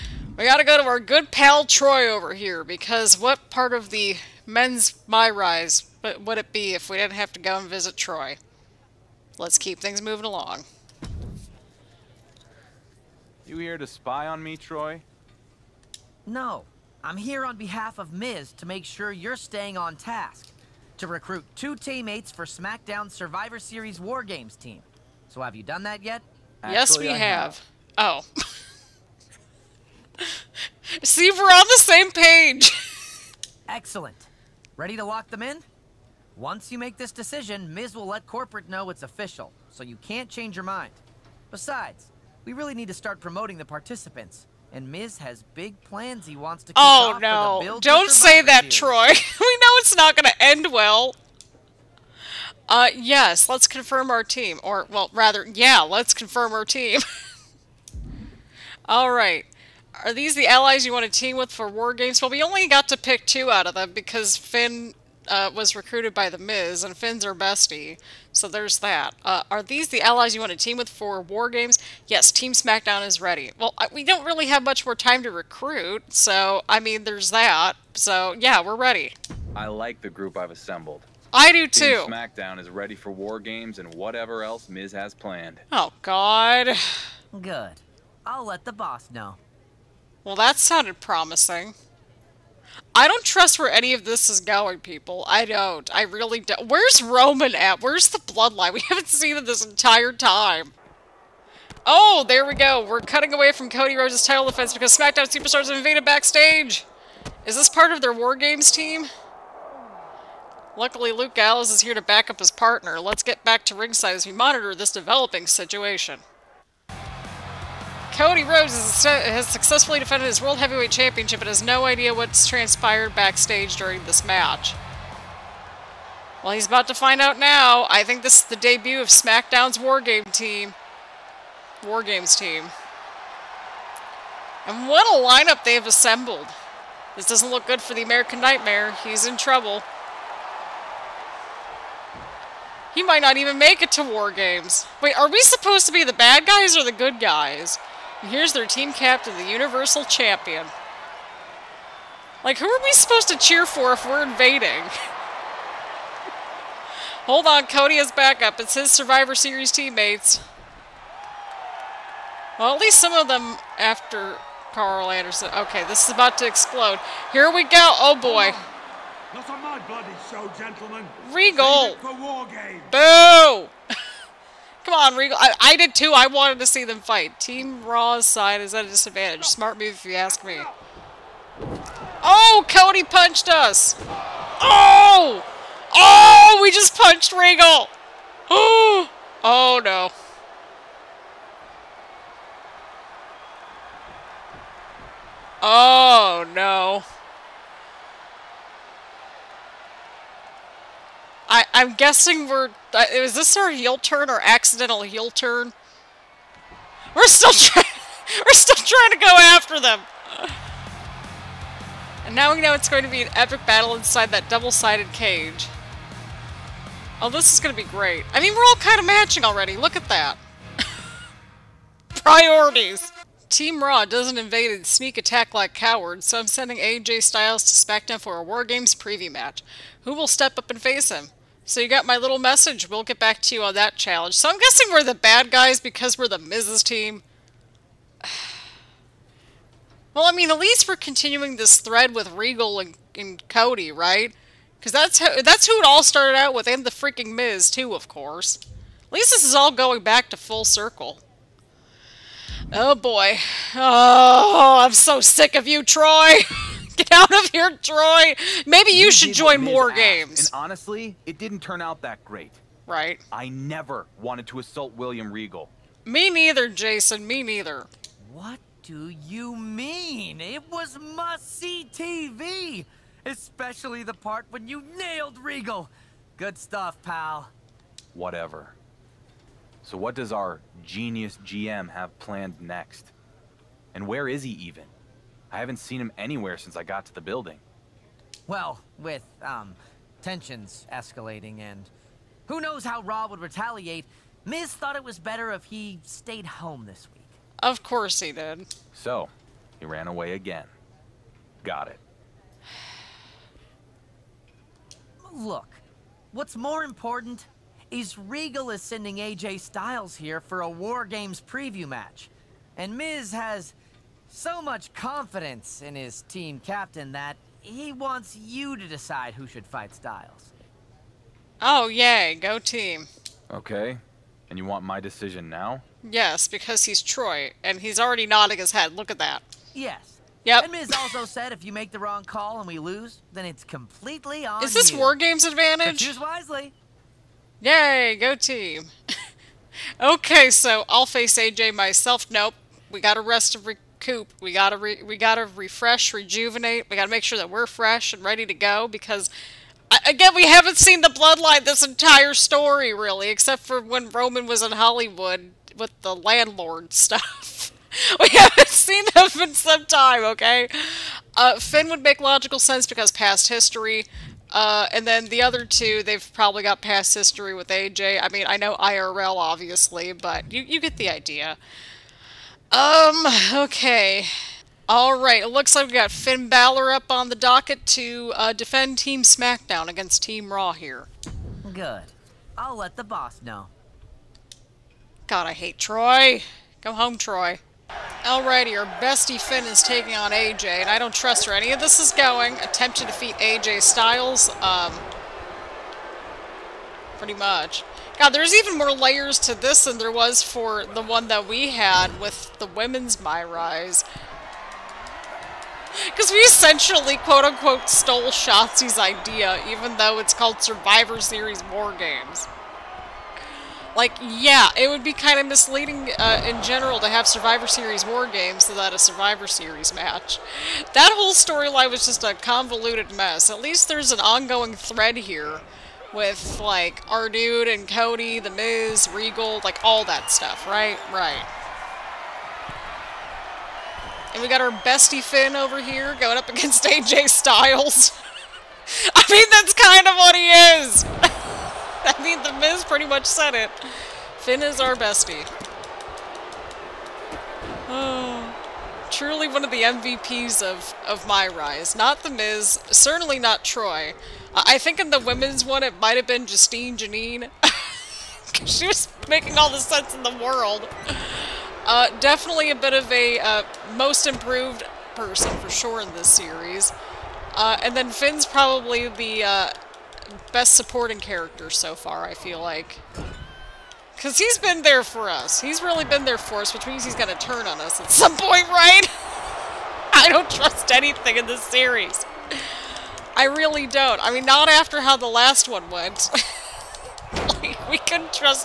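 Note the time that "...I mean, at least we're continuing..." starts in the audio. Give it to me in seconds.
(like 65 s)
240 s.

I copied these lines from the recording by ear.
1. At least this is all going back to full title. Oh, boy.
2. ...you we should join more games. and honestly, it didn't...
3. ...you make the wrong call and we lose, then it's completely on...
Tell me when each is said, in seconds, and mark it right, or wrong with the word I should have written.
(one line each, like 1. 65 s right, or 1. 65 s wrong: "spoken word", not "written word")
1. 249 s wrong: "circle", not "title"
2. 258 s right
3. 331 s right.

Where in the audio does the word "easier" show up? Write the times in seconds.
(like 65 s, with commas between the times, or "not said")
not said.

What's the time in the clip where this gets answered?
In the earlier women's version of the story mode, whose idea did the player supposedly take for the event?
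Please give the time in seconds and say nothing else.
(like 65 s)
408 s.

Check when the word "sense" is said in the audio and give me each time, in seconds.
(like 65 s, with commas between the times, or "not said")
362 s, 459 s.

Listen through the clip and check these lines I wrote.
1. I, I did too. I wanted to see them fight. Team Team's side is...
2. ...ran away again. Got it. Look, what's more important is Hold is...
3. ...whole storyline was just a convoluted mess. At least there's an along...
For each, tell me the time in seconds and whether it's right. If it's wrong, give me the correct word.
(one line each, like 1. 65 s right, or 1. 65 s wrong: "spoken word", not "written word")
1. 175 s wrong: "Raw", not "Team"
2. 299 s wrong: "Regal", not "Hold"
3. 421 s wrong: "ongoing", not "along".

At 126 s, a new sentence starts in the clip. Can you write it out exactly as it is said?
Well, he's about to find out now.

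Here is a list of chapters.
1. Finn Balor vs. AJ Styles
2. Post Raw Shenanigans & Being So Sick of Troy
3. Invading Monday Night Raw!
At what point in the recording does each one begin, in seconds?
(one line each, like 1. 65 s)
1. 386 s
2. 221 s
3. 99 s.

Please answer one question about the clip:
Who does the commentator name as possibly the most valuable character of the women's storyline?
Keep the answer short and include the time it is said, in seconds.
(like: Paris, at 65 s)
Justine Janine, at 456 s.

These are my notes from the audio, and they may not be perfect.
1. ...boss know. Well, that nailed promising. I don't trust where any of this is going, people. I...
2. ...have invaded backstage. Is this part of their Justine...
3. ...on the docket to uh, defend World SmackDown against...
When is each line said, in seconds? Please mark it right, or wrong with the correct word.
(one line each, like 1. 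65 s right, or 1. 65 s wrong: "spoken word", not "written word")
1. 88 s wrong: "sounded", not "nailed"
2. 105 s wrong: "War", not "Justine"
3. 377 s wrong: "Team", not "World".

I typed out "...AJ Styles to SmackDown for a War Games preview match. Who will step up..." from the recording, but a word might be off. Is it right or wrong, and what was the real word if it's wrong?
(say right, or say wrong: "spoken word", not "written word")
right.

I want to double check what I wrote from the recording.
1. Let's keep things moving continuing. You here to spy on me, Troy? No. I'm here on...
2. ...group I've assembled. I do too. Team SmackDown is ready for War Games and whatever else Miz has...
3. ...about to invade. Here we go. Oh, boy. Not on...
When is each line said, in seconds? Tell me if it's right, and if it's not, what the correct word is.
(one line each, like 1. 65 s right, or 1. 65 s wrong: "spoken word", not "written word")
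1. 9 s wrong: "along", not "continuing"
2. 80 s right
3. 166 s wrong: "explode", not "invade".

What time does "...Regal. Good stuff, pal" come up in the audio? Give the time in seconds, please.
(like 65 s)
275 s.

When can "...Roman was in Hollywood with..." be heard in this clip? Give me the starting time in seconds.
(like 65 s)
354 s.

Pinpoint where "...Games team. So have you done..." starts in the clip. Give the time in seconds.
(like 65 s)
24 s.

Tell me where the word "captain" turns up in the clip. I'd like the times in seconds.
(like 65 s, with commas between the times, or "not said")
148 s, 316 s.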